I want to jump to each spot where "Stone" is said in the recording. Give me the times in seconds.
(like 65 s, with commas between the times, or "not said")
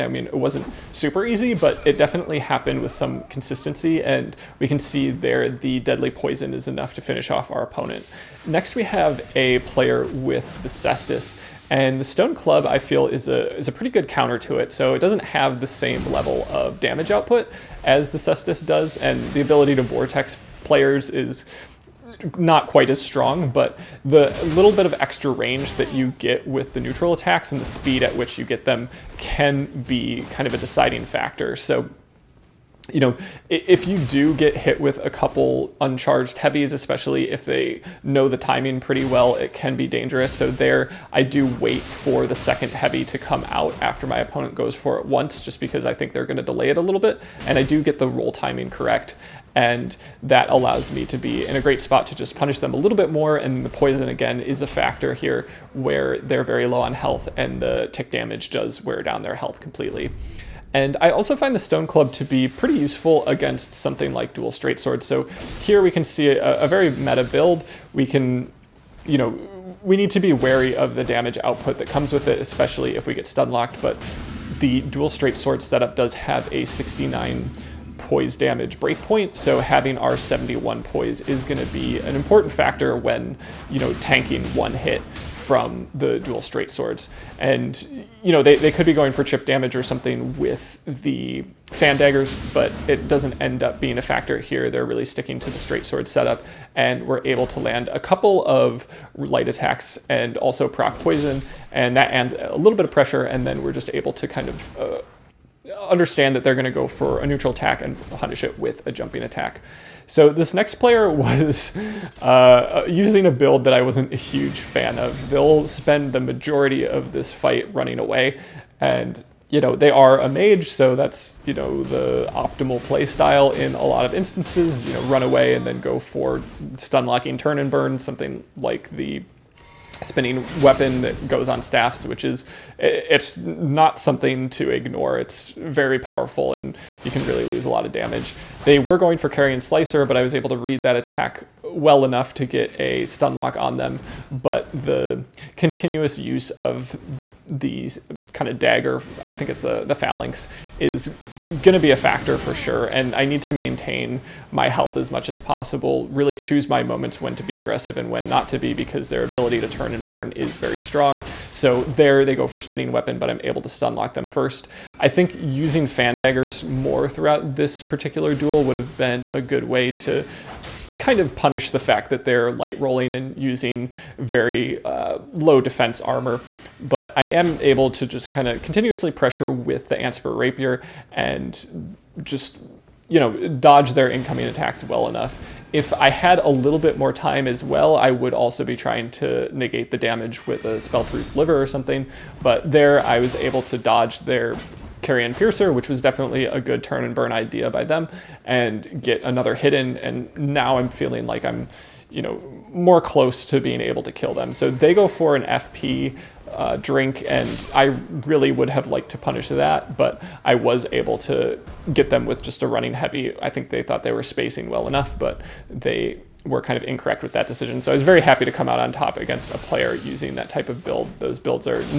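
12 s, 61 s.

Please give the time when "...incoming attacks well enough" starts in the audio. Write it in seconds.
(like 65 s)
184 s.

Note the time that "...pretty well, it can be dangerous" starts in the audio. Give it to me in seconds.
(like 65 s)
38 s.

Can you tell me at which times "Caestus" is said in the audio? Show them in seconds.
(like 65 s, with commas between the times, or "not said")
10 s, 18 s.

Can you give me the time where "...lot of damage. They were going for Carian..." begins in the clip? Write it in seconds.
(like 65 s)
137 s.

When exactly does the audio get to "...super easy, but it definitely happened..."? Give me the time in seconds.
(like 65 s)
0 s.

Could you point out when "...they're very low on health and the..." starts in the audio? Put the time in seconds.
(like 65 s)
56 s.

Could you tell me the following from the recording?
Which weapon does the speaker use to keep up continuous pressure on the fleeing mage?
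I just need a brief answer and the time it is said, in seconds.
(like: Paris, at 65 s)
Antspur Rapier, at 179 s.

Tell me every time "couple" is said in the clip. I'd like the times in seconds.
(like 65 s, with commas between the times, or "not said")
35 s, 97 s.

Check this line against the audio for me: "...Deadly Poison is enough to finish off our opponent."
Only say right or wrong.
right.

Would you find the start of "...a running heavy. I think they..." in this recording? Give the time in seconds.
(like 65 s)
212 s.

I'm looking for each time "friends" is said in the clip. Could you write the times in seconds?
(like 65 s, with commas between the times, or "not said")
not said.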